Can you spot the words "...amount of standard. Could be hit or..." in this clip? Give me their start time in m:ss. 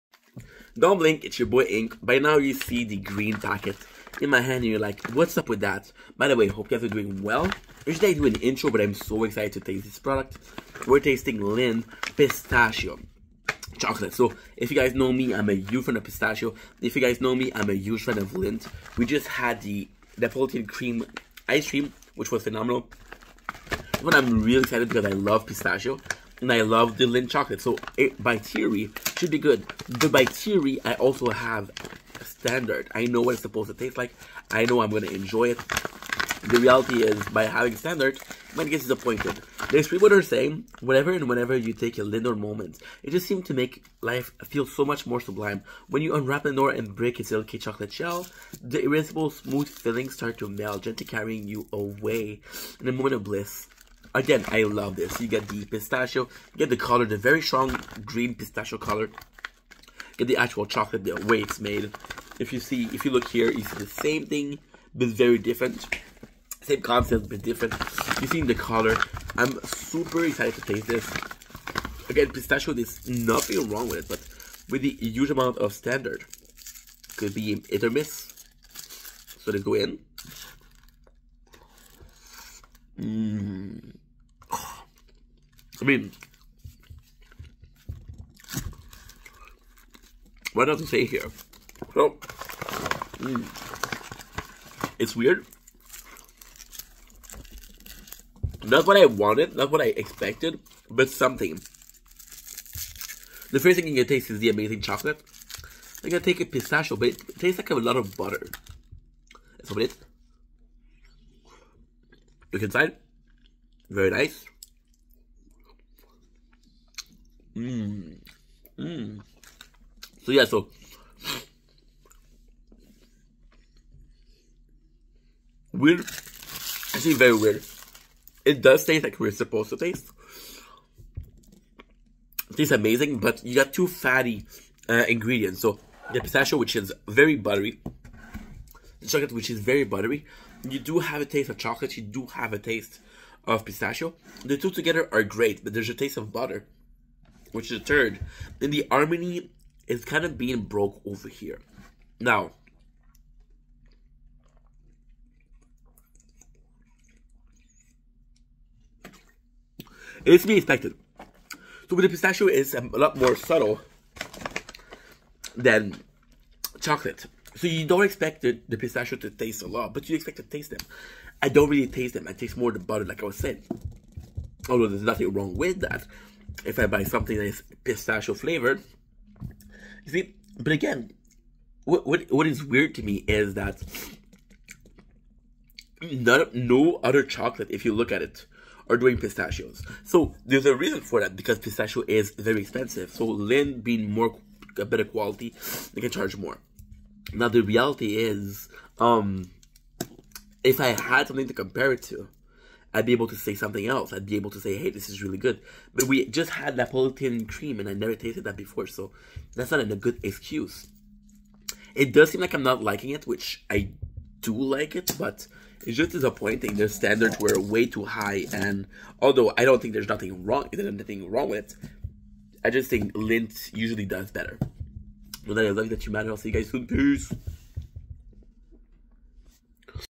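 1:15.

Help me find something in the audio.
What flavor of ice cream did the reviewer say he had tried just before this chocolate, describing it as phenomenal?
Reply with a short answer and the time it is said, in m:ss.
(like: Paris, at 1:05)
Neapolitan cream, at 0:20.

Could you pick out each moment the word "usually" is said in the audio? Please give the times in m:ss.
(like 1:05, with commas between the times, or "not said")
0:07, 3:43.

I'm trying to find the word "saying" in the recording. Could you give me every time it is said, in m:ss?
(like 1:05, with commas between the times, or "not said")
0:40, 2:53.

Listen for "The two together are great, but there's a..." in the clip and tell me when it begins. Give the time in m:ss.
2:24.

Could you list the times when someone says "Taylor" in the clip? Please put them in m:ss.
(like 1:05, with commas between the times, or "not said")
not said.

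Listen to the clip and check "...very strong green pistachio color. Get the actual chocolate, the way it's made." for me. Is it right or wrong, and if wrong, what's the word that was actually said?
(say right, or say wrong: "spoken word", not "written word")
right.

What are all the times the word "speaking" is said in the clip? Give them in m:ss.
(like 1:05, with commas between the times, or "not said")
not said.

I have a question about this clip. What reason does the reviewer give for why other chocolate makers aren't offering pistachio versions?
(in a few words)
Pistachio is very expensive.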